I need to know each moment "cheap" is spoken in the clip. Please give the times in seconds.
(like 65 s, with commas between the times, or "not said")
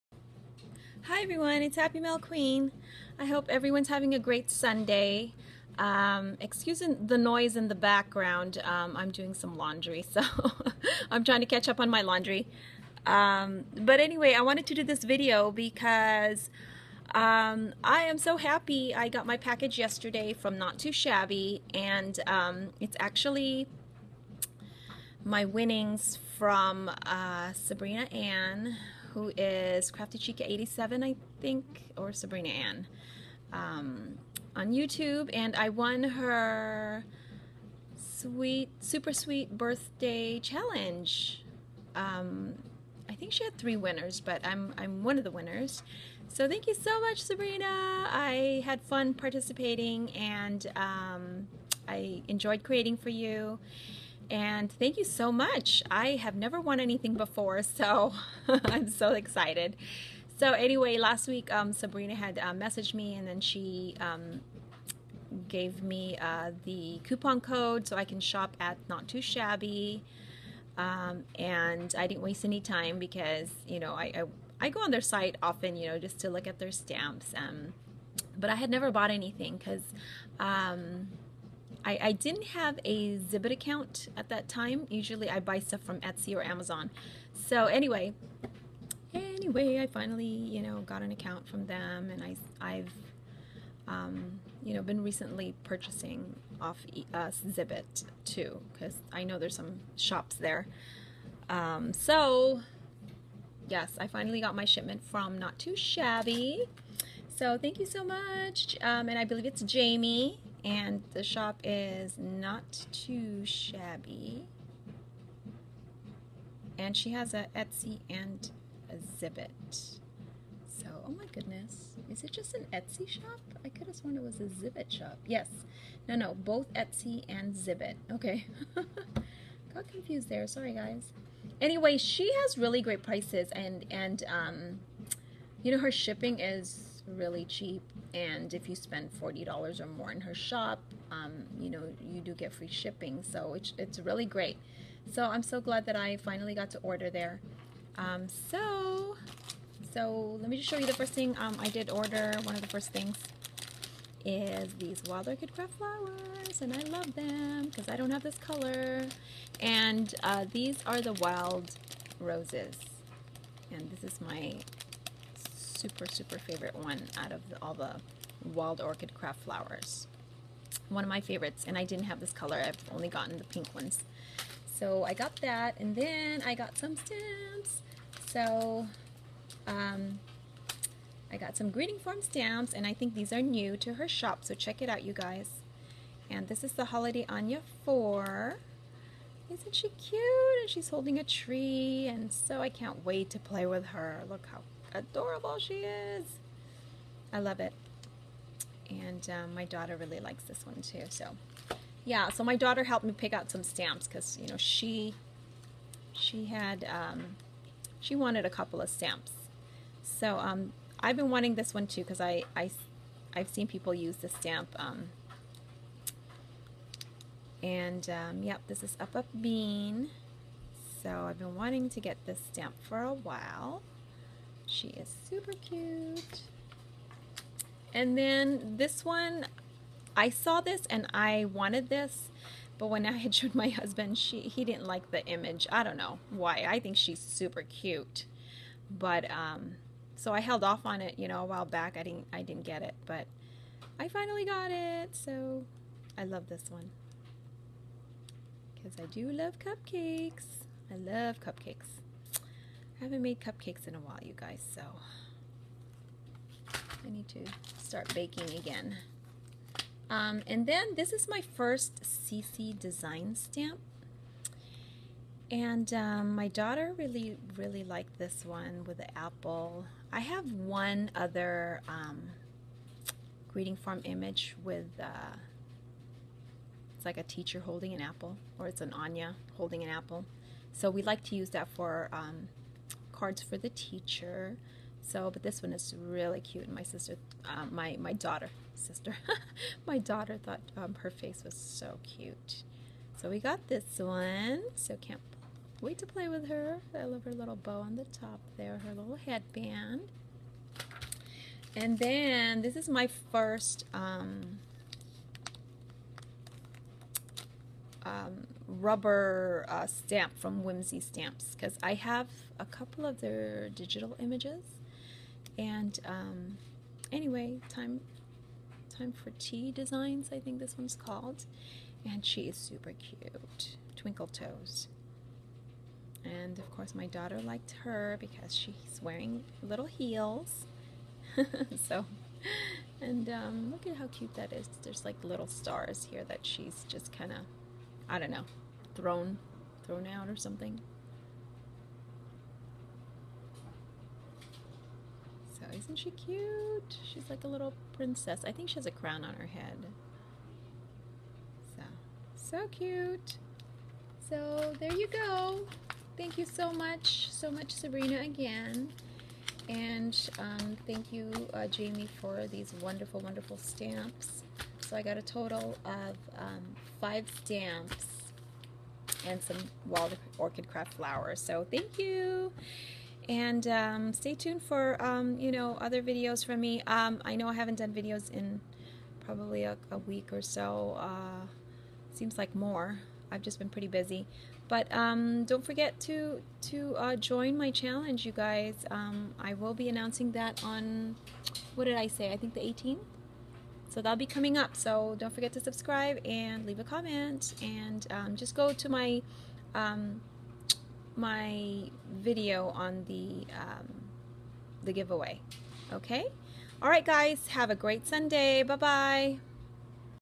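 137 s.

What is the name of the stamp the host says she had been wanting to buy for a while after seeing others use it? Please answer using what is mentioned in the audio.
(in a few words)
Up Up Bean.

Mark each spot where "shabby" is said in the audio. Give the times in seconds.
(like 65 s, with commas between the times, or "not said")
20 s, 69 s, 105 s, 113 s.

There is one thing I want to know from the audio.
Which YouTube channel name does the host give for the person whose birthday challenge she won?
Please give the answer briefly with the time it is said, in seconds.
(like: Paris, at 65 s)
Crafty Chica87, at 29 s.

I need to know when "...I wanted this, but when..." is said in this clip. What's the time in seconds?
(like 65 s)
231 s.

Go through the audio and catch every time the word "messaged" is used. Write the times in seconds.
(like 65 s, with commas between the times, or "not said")
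62 s.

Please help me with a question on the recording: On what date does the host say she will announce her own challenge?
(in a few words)
the 18th.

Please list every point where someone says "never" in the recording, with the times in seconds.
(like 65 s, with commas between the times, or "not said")
56 s, 78 s.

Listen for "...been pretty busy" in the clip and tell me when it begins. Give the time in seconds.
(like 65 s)
383 s.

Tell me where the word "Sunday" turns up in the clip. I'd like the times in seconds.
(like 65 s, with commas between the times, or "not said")
4 s, 408 s.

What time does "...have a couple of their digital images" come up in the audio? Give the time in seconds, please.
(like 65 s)
311 s.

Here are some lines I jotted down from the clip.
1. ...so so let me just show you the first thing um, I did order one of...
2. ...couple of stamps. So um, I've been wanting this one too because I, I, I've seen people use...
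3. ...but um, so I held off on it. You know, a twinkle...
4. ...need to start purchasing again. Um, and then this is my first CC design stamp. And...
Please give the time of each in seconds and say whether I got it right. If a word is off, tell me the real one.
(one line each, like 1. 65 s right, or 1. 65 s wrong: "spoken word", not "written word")
1. 148 s right
2. 208 s right
3. 238 s wrong: "while", not "twinkle"
4. 257 s wrong: "baking", not "purchasing".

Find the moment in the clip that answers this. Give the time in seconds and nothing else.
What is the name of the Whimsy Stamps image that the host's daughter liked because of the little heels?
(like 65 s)
323 s.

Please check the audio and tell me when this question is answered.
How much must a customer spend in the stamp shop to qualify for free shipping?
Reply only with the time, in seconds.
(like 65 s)
139 s.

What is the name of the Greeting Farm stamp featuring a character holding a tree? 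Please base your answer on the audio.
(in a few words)
Holiday Anya 4.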